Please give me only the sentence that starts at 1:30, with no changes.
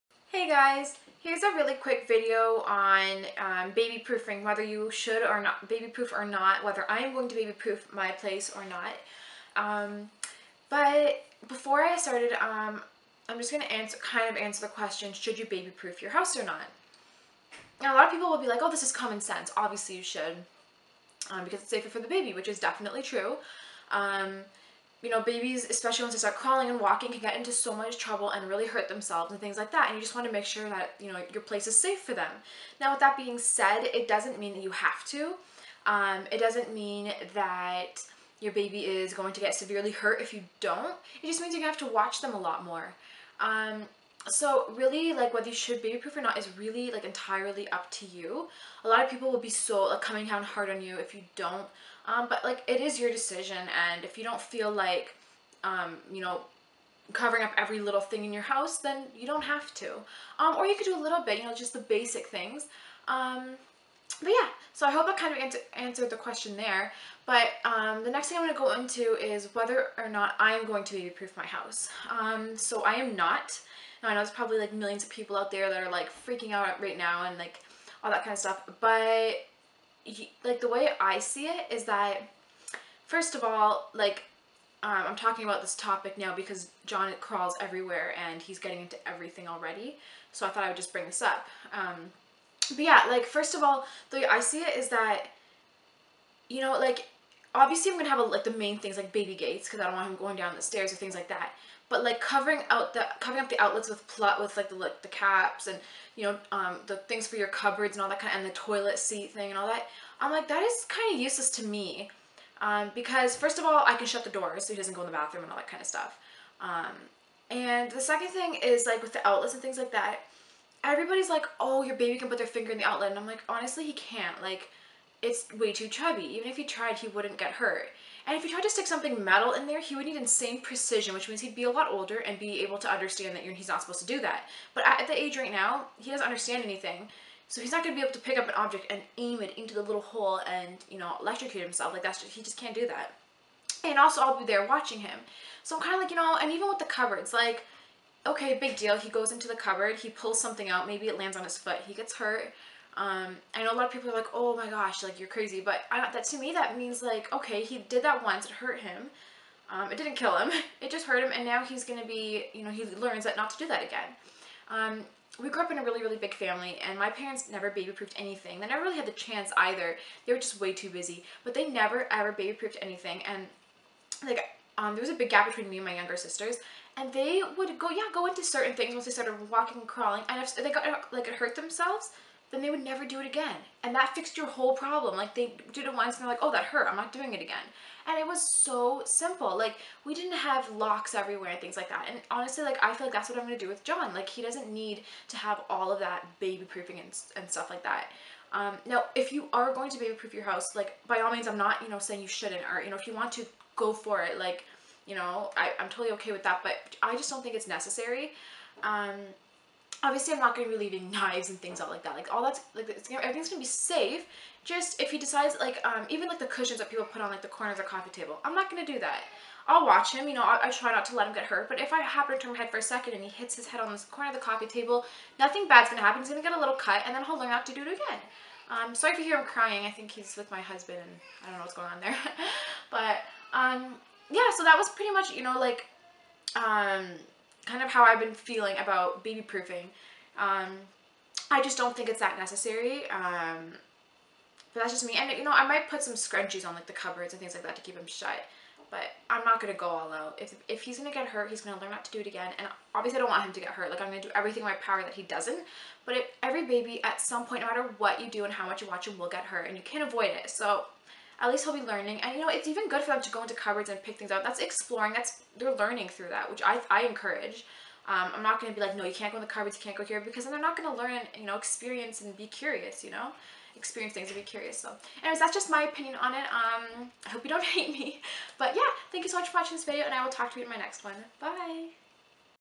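So I thought I would just bring this up.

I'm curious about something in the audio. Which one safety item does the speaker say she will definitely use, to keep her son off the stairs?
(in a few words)
baby gates.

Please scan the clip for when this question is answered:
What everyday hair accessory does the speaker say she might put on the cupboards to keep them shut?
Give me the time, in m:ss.
4:06.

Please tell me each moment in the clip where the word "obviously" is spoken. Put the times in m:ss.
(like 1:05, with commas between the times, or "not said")
0:19, 1:37, 3:30, 4:12.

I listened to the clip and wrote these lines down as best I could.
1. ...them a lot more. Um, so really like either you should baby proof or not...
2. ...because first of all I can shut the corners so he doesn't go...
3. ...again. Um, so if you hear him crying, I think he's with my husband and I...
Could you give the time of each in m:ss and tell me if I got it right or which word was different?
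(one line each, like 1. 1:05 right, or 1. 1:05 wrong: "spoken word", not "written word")
1. 0:42 wrong: "whether", not "either"
2. 1:52 wrong: "doors", not "corners"
3. 3:47 right.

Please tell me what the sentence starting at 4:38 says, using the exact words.
But yeah, thank you so much for watching this video and I will talk to you in my next one.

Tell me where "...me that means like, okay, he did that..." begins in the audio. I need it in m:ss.
2:36.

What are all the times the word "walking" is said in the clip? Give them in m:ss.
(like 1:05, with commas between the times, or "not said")
0:26, 2:59.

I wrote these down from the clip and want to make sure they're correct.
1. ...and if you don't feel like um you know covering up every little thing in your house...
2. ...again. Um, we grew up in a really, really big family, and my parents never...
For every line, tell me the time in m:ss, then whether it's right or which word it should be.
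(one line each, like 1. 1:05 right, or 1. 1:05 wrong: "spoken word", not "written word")
1. 0:53 right
2. 2:43 right.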